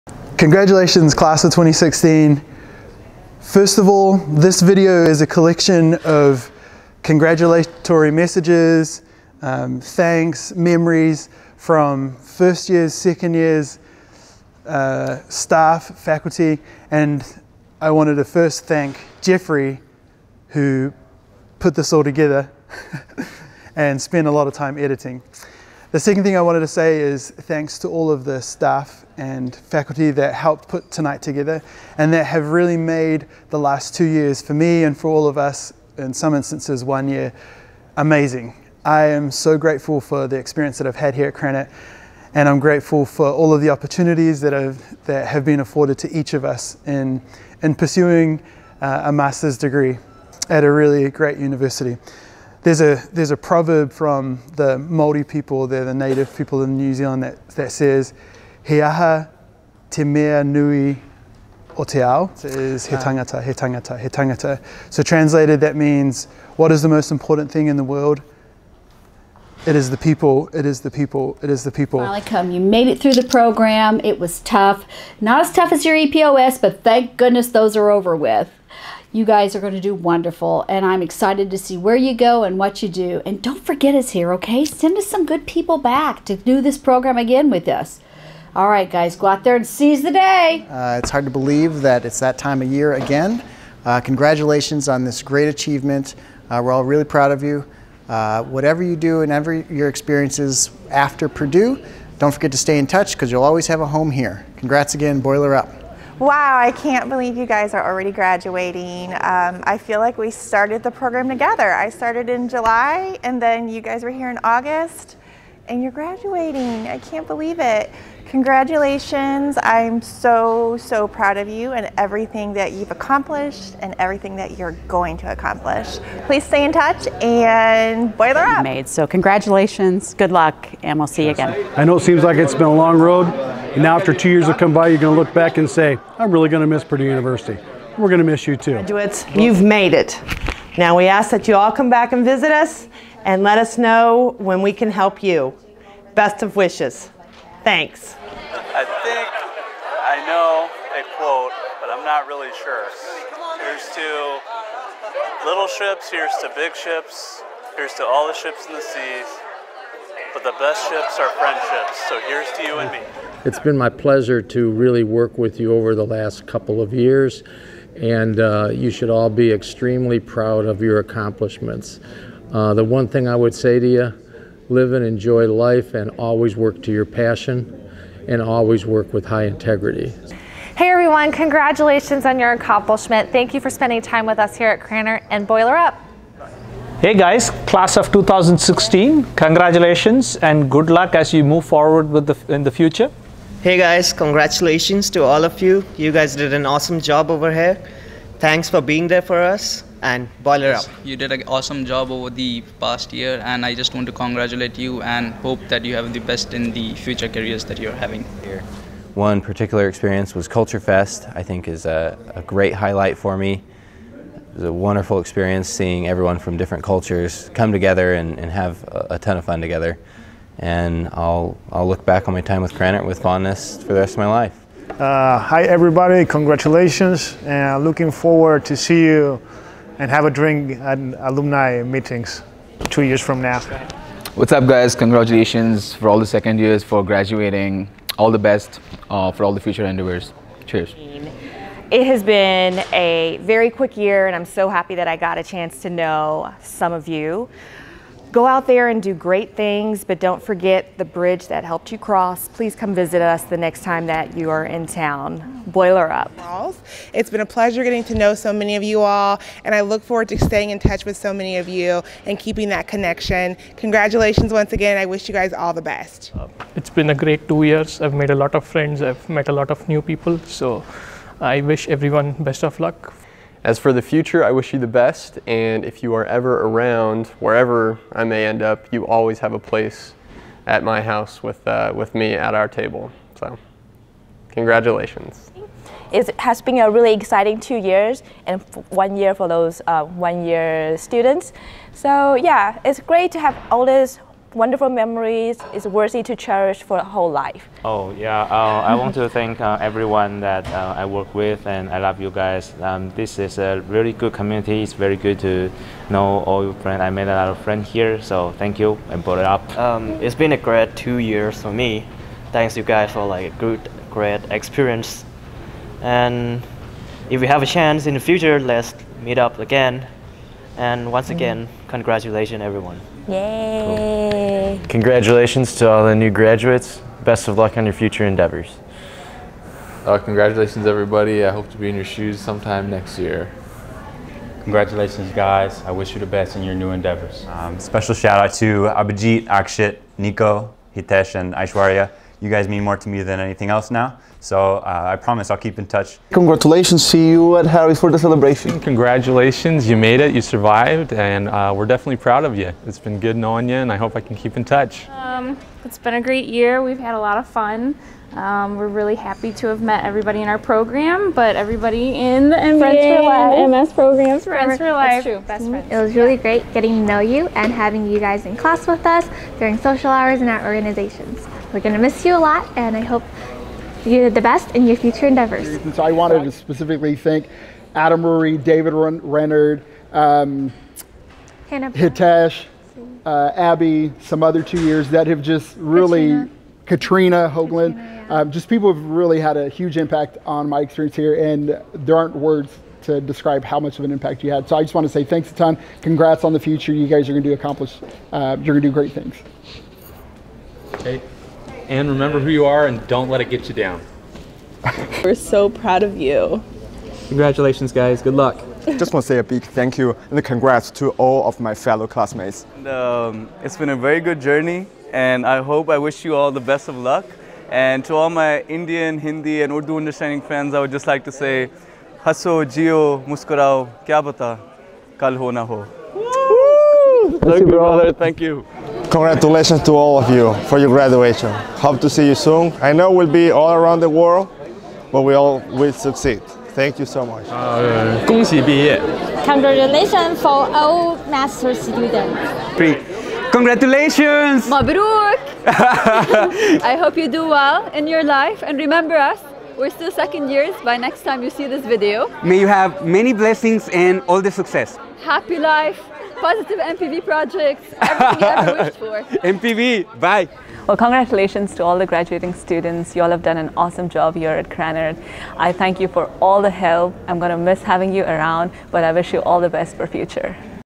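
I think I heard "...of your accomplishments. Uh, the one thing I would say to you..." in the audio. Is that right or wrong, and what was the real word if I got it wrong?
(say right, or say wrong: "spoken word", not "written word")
right.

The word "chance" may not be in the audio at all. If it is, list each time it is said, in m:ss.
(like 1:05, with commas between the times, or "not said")
4:05, 5:17.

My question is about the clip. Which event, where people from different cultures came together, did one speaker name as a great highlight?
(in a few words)
Culture Fest.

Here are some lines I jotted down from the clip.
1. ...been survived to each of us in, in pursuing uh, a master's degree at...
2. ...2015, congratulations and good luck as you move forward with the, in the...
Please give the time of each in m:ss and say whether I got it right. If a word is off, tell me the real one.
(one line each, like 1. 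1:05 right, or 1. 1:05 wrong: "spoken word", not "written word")
1. 0:45 wrong: "afforded", not "survived"
2. 3:08 wrong: "2016", not "2015".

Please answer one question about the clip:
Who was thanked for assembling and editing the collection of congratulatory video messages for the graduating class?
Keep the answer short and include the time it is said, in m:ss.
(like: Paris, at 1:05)
Jeffery, at 0:19.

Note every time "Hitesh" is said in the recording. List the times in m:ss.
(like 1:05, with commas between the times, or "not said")
5:40, 6:21.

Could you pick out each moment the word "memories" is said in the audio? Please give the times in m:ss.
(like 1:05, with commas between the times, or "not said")
0:10, 4:54.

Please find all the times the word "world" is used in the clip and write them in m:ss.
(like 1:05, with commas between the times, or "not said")
1:07, 7:14.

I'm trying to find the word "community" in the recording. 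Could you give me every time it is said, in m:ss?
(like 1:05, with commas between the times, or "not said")
5:04.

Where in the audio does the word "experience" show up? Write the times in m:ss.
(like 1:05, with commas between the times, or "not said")
0:40, 1:39, 3:29, 3:35, 5:14, 6:30.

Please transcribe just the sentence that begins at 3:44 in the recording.
Uh, hi everybody, congratulations, and looking forward to see you and have a drink at alumni meetings two years from now.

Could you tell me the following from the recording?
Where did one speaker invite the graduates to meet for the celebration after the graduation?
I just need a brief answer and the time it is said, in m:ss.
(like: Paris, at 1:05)
Harry's, at 5:47.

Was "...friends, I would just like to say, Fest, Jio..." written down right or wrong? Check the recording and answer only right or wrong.
wrong.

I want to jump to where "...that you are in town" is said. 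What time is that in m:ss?
4:14.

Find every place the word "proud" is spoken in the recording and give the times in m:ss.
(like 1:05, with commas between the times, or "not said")
1:37, 2:01, 2:50, 5:52, 6:45.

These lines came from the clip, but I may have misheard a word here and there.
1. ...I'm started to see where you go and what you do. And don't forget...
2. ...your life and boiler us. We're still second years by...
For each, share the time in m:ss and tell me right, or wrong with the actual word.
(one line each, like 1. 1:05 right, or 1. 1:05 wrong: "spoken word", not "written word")
1. 1:20 wrong: "excited", not "started"
2. 7:28 wrong: "remember", not "boiler".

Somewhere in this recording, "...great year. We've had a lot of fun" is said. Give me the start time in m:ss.
5:56.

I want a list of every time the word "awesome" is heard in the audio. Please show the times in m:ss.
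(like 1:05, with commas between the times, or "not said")
3:16, 3:21, 7:43.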